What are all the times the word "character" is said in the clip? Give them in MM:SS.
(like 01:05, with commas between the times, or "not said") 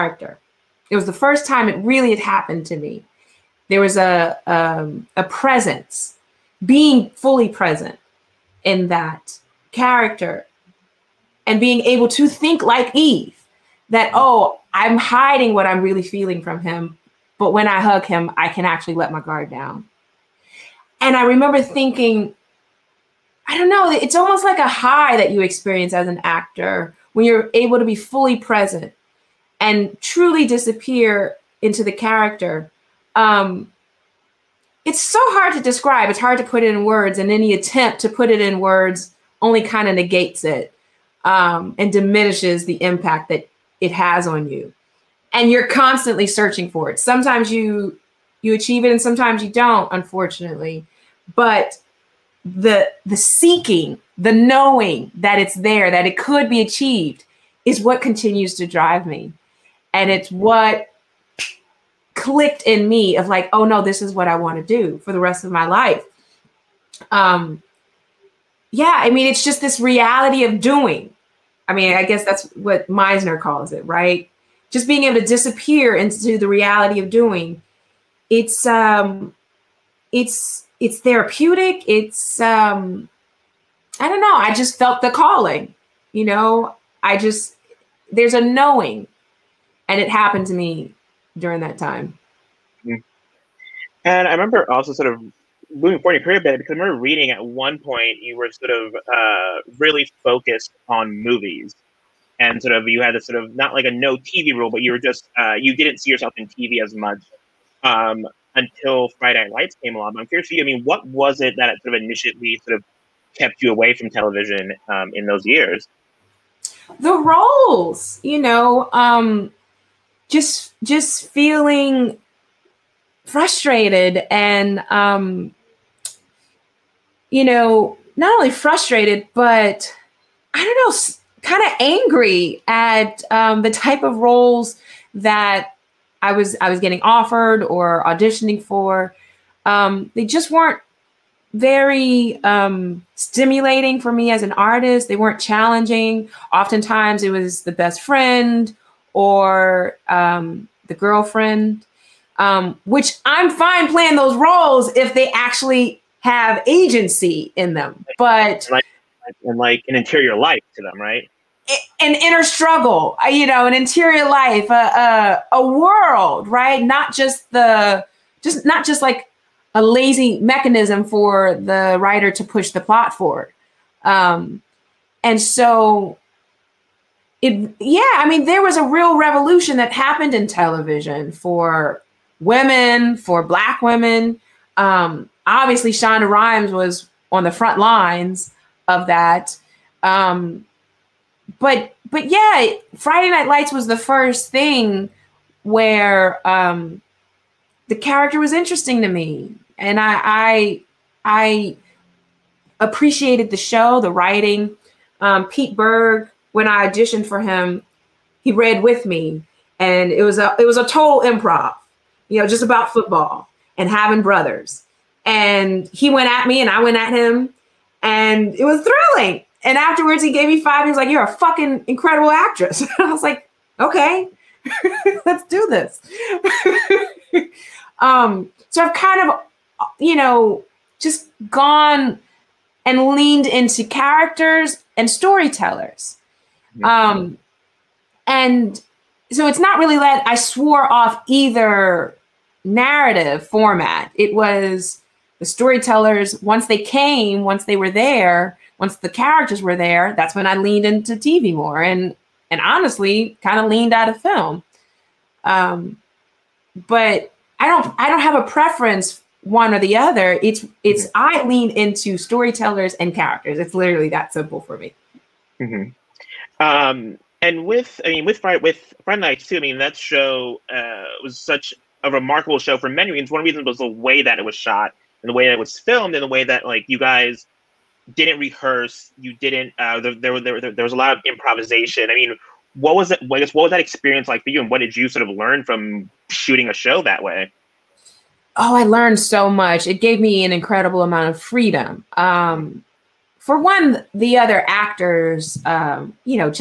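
00:09, 00:31, 03:17, 03:53, 04:09, 04:23.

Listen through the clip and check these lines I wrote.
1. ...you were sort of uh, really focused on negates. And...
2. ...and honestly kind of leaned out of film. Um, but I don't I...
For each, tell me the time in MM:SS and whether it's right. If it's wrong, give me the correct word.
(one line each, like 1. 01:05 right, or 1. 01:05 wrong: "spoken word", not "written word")
1. 01:38 wrong: "movies", not "negates"
2. 04:12 right.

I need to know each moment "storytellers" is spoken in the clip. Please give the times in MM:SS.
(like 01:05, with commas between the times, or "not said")
03:55, 04:05, 04:22.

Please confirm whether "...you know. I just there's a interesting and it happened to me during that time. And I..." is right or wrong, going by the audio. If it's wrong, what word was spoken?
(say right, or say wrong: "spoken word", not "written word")
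wrong: "knowing", not "interesting".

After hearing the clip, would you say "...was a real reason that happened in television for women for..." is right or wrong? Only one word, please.
wrong.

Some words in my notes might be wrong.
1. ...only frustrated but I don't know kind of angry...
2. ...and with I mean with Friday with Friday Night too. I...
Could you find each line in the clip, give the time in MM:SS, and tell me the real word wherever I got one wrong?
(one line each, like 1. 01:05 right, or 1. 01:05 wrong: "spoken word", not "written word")
1. 02:08 right
2. 04:27 right.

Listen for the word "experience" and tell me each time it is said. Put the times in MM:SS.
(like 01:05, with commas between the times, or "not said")
00:25, 04:43.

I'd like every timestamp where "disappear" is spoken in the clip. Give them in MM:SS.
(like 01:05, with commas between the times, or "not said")
00:30, 01:15.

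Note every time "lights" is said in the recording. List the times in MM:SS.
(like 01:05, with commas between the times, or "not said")
01:49, 03:13.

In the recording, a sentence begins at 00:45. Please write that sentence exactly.
And you're constantly searching for it.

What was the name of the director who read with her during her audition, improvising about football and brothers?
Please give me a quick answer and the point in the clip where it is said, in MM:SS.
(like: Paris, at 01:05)
Pete Berg, at 03:25.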